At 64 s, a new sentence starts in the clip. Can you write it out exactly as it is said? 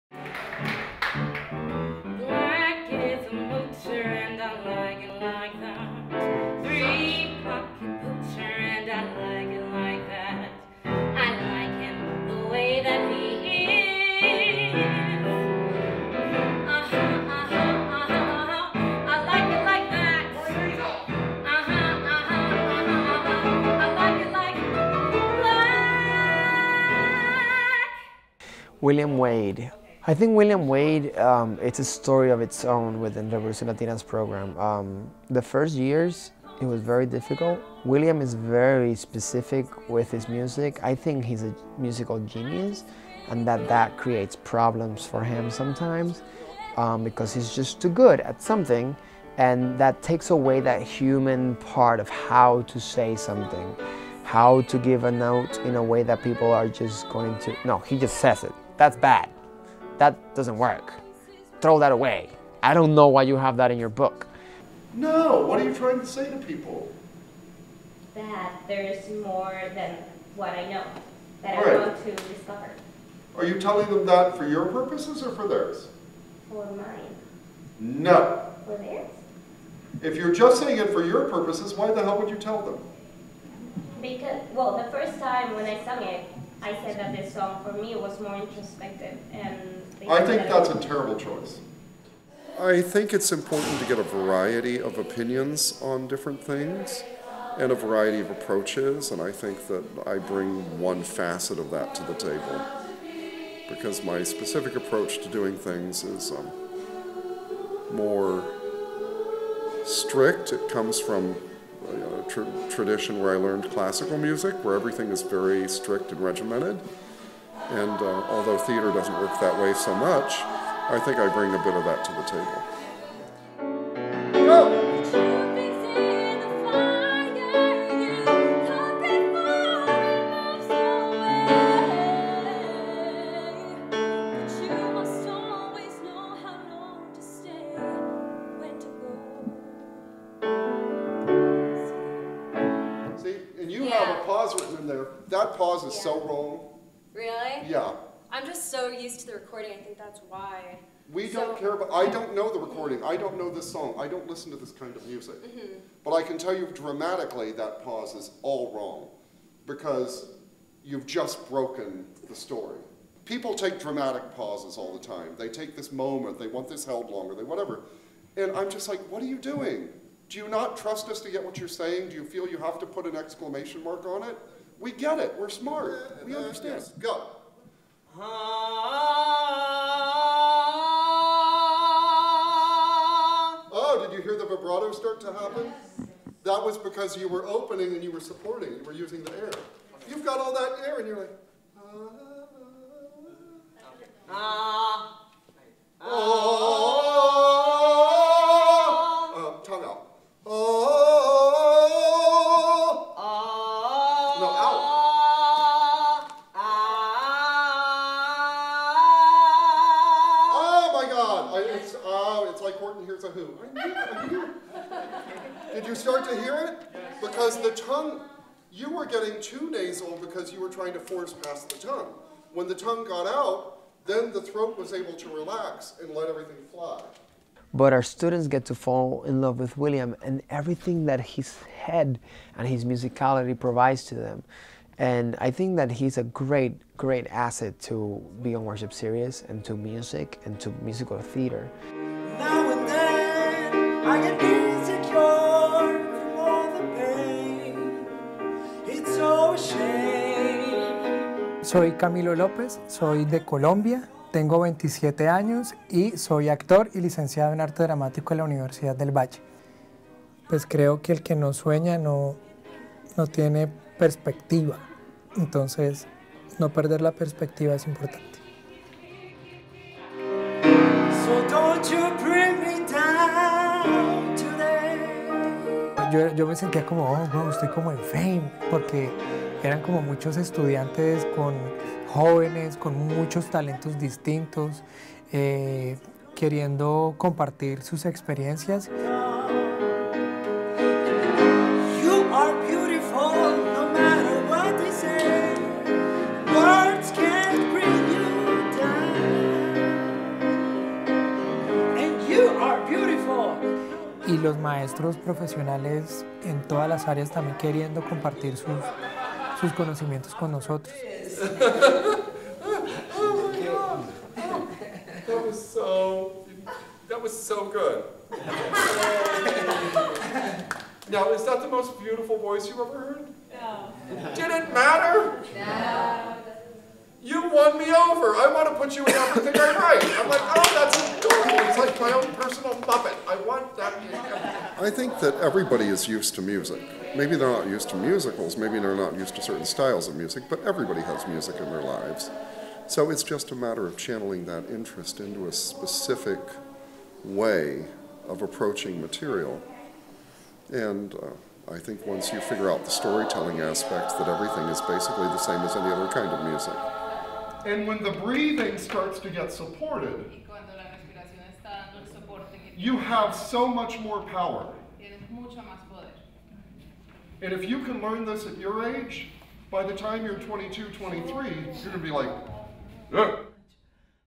No, what are you trying to say to people?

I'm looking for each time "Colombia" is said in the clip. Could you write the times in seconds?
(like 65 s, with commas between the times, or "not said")
253 s.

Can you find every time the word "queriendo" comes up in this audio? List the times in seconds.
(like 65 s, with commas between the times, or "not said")
286 s, 307 s.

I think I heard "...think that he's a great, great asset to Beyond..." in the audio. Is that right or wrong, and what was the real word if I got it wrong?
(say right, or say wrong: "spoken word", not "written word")
right.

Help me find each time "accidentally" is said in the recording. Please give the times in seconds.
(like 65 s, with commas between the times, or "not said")
not said.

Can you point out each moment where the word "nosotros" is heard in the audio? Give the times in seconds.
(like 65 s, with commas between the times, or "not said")
310 s.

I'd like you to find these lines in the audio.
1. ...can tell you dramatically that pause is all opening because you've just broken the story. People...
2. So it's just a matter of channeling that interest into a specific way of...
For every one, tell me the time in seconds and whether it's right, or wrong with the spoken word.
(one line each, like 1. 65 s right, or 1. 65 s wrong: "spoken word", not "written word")
1. 156 s wrong: "wrong", not "opening"
2. 342 s right.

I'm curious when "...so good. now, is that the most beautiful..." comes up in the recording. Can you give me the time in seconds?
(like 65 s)
317 s.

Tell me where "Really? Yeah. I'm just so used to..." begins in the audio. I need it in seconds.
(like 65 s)
147 s.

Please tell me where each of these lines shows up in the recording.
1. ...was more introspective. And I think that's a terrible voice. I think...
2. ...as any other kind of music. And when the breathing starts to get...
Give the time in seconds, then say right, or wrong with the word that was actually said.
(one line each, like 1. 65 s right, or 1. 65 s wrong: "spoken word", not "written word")
1. 87 s wrong: "choice", not "voice"
2. 355 s right.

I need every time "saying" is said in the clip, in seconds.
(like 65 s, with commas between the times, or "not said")
80 s, 171 s.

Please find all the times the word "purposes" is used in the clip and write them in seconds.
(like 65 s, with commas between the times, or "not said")
74 s, 81 s.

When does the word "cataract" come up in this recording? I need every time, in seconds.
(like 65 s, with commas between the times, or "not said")
not said.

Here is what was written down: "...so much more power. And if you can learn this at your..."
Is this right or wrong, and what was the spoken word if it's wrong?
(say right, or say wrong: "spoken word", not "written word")
right.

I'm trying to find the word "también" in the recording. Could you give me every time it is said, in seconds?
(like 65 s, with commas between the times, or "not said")
307 s.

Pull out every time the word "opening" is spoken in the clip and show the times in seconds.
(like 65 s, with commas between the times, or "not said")
187 s.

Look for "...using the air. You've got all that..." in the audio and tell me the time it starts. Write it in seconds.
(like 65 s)
188 s.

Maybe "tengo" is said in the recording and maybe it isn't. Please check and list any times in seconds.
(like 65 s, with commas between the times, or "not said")
254 s.